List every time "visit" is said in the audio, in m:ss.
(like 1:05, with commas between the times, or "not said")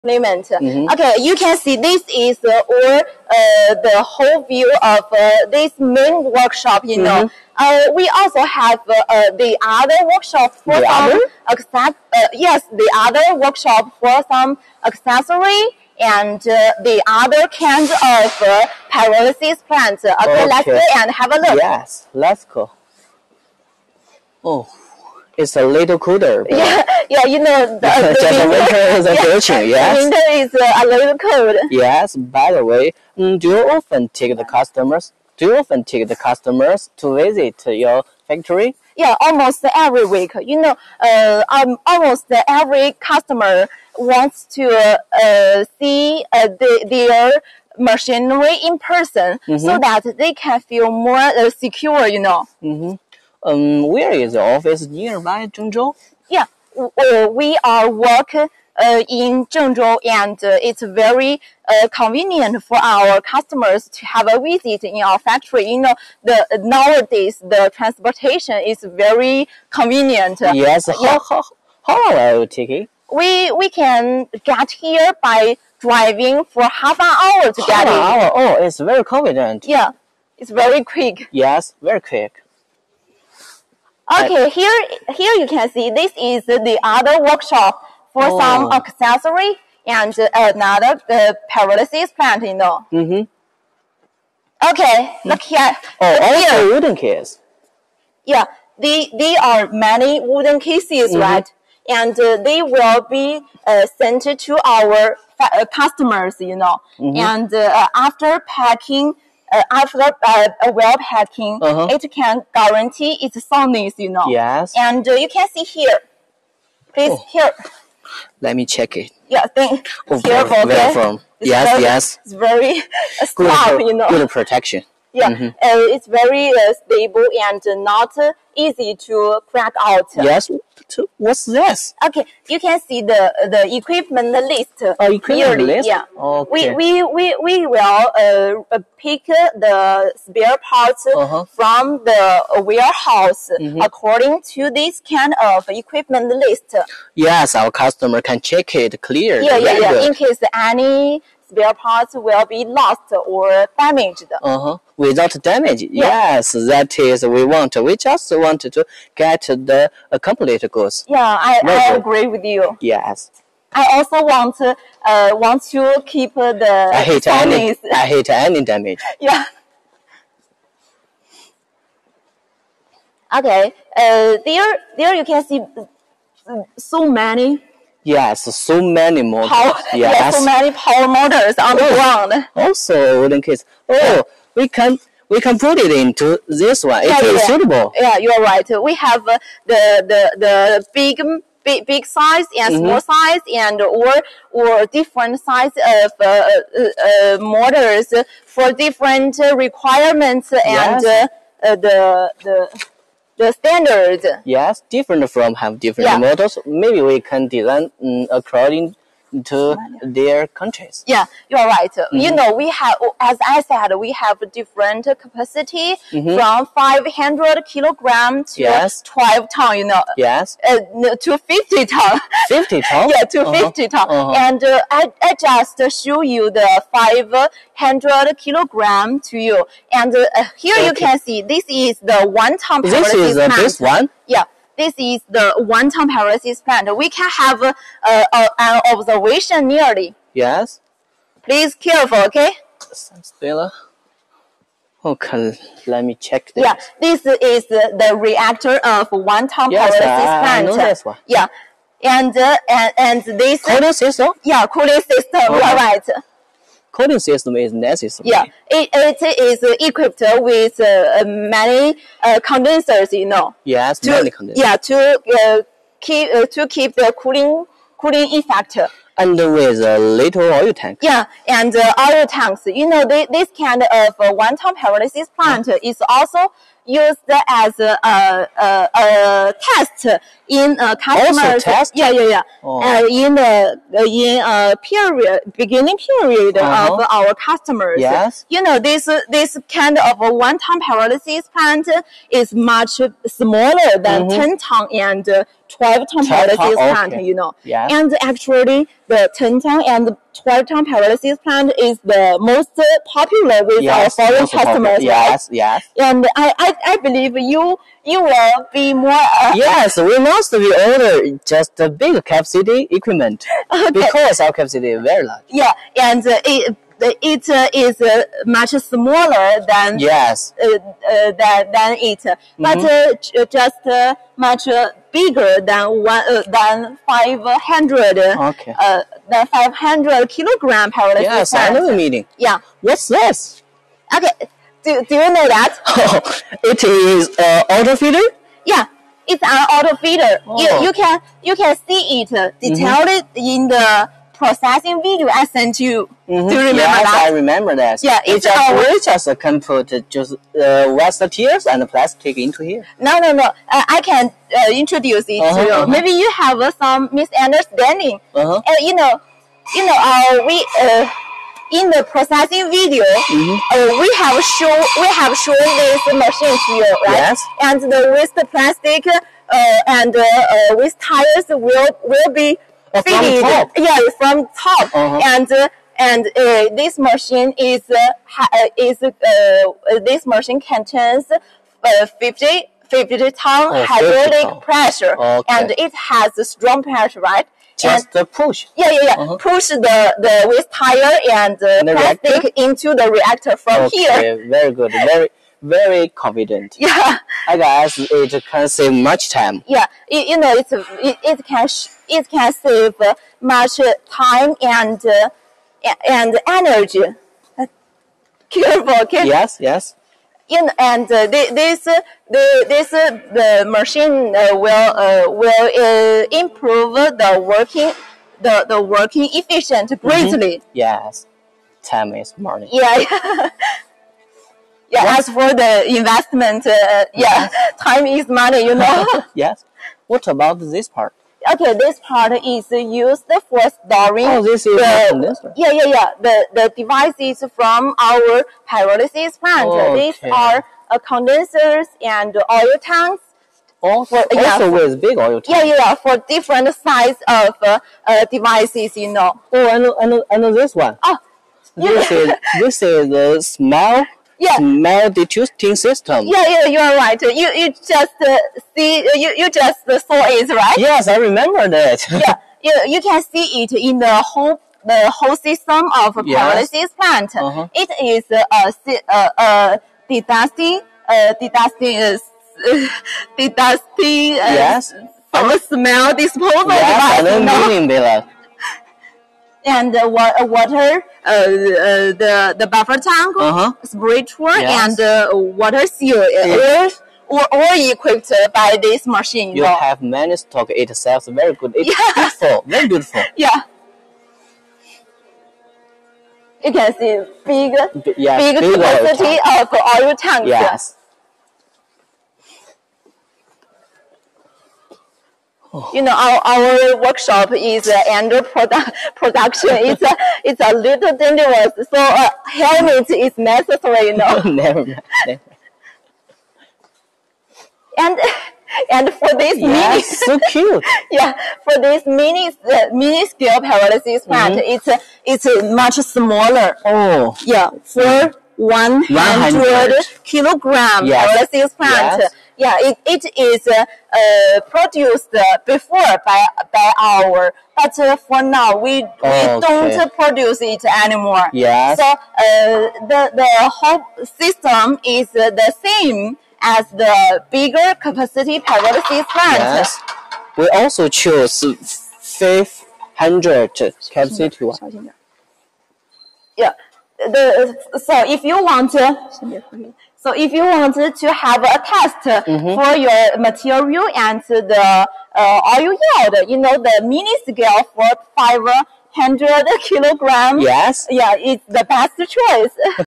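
0:37, 1:04.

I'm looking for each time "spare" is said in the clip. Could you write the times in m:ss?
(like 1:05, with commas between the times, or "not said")
2:20, 2:31.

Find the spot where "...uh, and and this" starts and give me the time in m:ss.
4:12.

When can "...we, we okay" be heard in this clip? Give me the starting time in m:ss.
8:58.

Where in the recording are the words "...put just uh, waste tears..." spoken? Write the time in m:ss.
5:49.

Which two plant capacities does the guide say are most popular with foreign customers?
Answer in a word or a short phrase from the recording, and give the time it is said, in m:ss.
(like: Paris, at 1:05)
10-ton and 12-ton, at 4:59.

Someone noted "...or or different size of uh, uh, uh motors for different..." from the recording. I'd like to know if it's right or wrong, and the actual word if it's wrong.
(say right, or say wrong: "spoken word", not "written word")
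right.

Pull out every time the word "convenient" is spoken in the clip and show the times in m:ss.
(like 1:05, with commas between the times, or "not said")
1:01, 1:09, 1:19.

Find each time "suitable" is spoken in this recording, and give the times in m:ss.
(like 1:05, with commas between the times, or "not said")
3:07.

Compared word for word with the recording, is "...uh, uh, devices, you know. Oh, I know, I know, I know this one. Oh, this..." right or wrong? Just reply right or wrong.
right.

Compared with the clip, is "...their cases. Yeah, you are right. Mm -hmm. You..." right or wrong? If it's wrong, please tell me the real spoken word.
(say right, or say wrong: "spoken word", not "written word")
wrong: "countries", not "cases".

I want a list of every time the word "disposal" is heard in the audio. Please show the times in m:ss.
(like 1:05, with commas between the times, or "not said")
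7:56.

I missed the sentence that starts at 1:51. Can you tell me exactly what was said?
it can guarantee its soundness, you know.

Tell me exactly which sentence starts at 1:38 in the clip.
Yeah, they, they are many wooden cases, mm-hmm.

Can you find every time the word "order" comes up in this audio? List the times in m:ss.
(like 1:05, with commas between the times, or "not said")
5:10.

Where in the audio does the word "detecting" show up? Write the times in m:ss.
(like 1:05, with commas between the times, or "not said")
7:35.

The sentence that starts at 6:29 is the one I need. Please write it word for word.
push the the waste tire and, and the plastic reactor?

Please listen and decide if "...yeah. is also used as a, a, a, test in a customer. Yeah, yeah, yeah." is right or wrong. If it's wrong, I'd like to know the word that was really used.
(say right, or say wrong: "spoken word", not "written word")
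right.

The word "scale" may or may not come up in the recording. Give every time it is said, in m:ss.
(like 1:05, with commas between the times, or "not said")
8:43, 9:27.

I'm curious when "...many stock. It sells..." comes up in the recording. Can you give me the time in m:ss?
8:10.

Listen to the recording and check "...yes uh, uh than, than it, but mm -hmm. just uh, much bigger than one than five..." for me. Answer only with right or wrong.
right.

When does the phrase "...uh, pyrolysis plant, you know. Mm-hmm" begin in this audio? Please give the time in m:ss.
1:31.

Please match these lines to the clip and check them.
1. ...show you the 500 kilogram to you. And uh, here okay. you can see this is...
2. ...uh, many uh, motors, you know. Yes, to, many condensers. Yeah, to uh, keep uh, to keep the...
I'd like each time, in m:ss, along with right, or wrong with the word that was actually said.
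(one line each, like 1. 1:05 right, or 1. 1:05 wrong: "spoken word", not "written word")
1. 3:46 right
2. 4:20 wrong: "condensers", not "motors".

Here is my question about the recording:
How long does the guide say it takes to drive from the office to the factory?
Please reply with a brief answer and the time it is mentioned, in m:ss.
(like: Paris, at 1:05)
half an hour, at 1:16.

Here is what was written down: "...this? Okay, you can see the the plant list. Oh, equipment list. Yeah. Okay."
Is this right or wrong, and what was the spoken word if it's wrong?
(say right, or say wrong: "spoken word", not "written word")
wrong: "equipment", not "plant".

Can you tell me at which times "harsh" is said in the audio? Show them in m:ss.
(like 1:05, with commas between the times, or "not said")
not said.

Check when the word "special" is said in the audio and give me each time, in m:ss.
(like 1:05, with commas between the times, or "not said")
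not said.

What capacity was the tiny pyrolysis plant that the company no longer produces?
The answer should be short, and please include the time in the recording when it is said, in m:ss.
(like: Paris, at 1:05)
100 kilogram, at 8:48.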